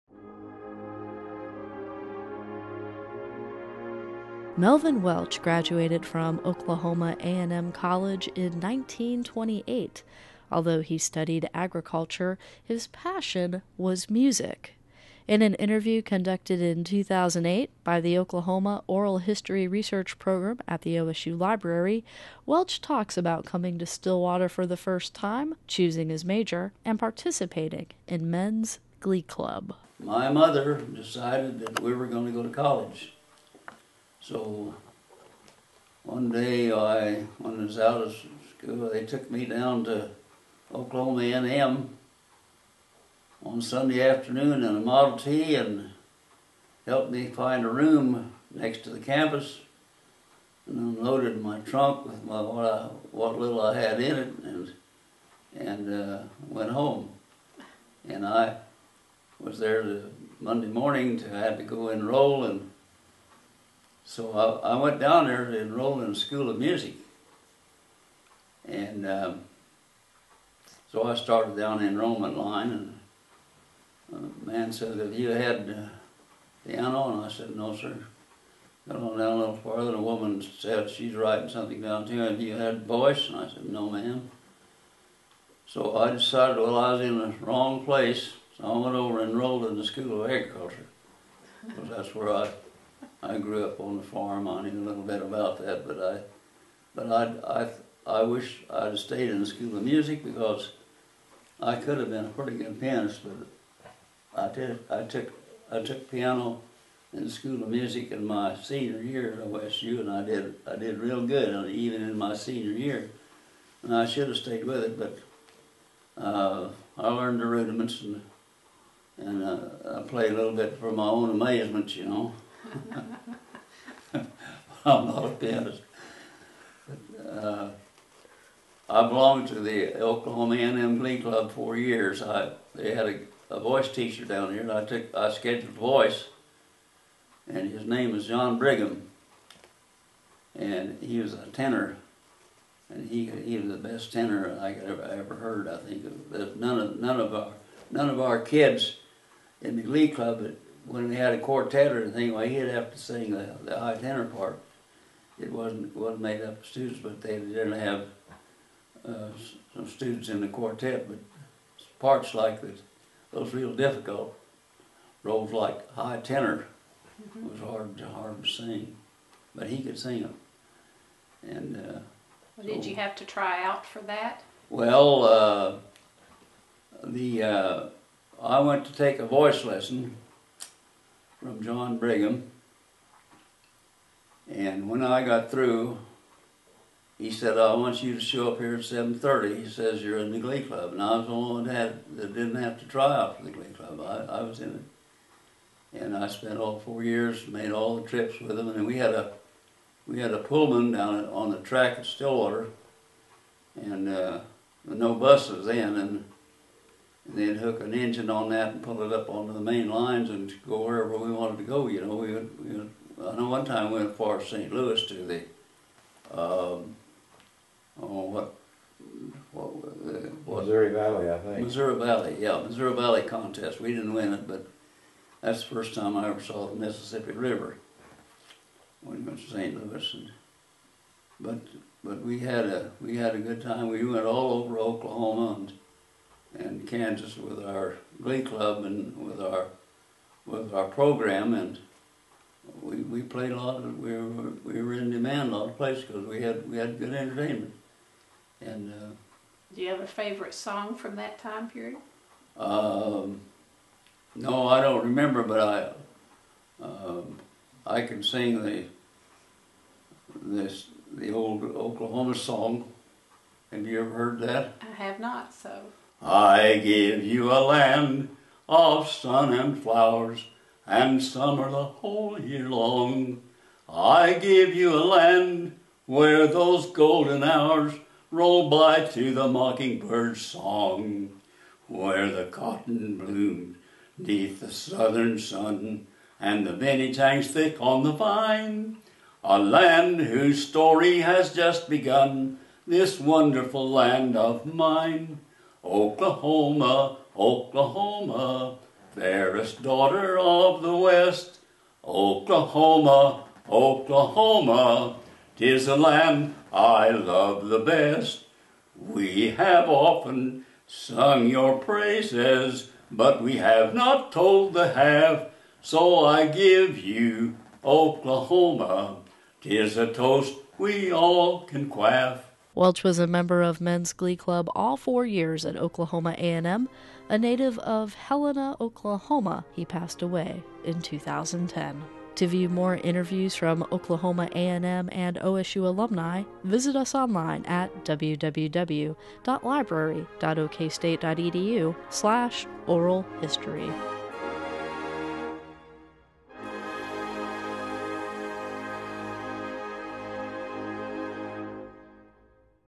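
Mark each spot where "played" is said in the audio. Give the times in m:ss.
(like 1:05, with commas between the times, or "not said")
2:00, 4:03.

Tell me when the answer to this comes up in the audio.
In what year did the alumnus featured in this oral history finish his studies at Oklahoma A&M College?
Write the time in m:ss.
0:08.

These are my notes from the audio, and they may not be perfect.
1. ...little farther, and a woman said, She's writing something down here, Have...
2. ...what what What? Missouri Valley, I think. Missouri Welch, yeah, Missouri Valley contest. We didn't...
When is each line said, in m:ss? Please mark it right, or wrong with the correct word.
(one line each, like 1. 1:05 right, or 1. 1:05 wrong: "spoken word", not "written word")
1. 1:19 right
2. 3:38 wrong: "Valley", not "Welch".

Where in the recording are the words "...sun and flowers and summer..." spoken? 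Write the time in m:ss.
4:29.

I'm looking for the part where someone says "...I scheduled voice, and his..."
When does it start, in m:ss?
2:15.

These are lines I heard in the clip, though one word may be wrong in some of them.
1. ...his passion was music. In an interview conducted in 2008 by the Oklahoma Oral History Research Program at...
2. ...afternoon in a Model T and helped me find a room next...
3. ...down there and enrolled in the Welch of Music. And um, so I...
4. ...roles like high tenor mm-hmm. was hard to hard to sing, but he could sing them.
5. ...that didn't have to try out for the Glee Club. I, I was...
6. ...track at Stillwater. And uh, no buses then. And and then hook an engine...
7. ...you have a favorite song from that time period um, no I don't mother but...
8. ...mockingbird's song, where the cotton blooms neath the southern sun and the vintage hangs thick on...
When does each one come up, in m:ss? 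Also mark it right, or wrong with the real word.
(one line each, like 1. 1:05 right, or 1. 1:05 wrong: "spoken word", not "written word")
1. 0:12 right
2. 0:44 right
3. 1:04 wrong: "School", not "Welch"
4. 2:45 right
5. 3:12 right
6. 3:21 right
7. 4:09 wrong: "remember", not "mother"
8. 4:39 right.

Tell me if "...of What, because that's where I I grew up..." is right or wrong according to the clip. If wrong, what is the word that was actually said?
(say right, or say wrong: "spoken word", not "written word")
wrong: "Agriculture", not "What".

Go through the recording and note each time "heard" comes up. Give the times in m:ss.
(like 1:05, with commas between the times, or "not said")
2:25, 4:24.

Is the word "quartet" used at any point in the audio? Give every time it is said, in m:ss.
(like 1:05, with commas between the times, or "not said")
2:31, 2:40.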